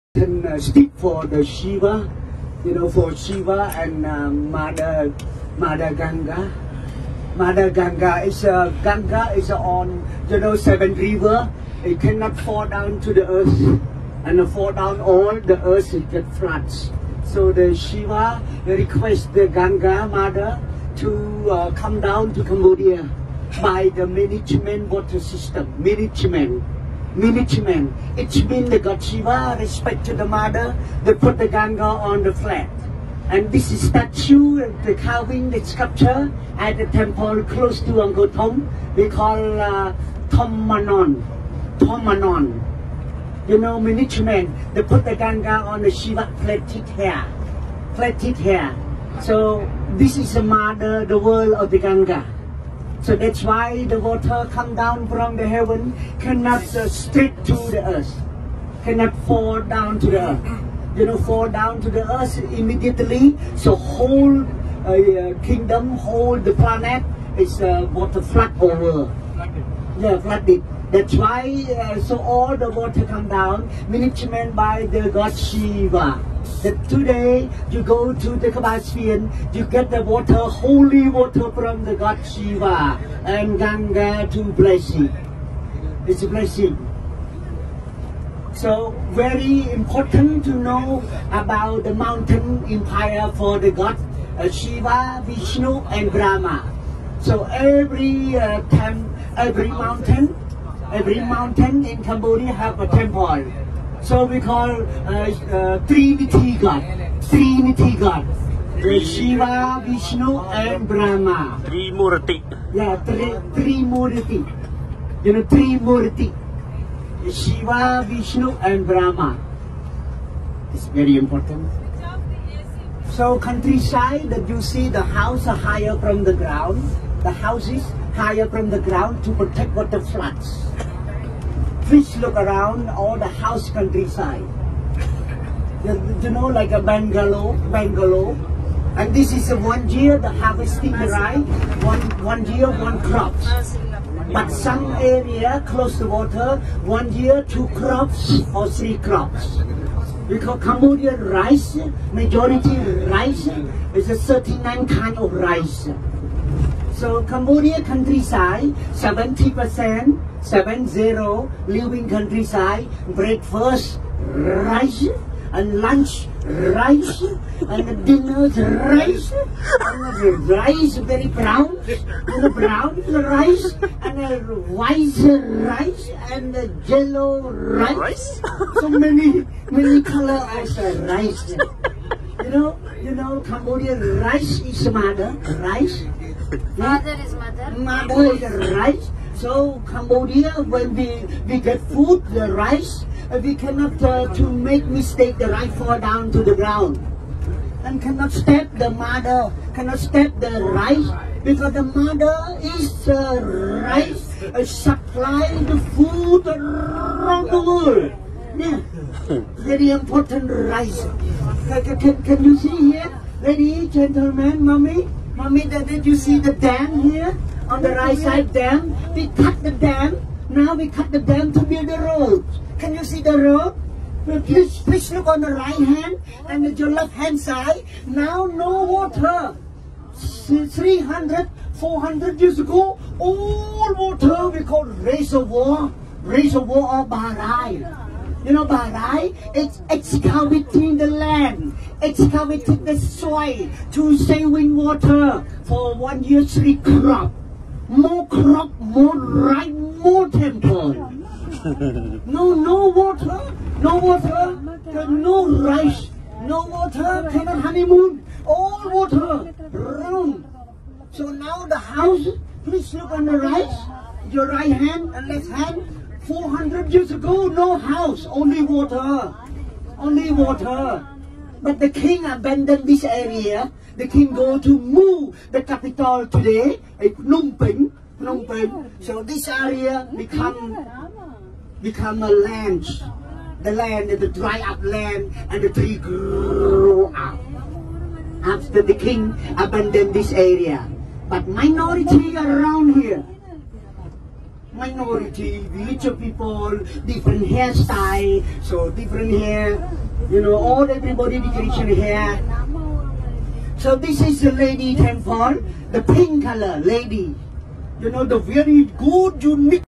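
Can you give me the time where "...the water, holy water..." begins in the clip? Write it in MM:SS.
01:19.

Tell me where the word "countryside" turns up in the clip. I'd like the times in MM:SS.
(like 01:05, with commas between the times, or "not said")
02:03, 02:13, 02:37, 02:42.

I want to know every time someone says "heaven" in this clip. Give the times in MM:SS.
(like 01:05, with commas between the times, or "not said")
00:55.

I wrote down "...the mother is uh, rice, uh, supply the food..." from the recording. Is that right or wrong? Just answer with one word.
right.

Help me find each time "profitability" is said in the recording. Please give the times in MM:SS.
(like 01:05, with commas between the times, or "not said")
not said.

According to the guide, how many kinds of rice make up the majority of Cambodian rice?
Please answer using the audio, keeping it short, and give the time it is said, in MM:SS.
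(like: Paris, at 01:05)
39, at 02:34.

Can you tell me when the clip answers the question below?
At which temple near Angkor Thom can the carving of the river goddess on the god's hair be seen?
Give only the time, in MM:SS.
00:40.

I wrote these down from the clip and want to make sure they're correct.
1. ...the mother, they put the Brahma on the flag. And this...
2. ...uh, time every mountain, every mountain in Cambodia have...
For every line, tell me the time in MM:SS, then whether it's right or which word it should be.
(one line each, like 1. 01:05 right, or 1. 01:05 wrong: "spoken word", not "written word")
1. 00:30 wrong: "Ganga", not "Brahma"
2. 01:38 right.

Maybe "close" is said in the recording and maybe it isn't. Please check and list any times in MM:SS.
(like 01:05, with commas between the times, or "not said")
00:37, 02:25.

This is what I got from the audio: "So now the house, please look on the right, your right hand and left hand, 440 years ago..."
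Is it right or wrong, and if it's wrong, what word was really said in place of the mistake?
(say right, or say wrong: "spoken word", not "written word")
wrong: "400", not "440".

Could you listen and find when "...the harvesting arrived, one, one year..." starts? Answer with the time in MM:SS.
02:20.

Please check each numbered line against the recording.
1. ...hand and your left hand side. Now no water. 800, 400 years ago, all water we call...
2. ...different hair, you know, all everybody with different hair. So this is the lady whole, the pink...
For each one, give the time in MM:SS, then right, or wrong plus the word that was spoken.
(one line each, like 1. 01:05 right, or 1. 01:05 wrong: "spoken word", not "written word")
1. 03:45 wrong: "300", not "800"
2. 04:58 wrong: "temple", not "whole".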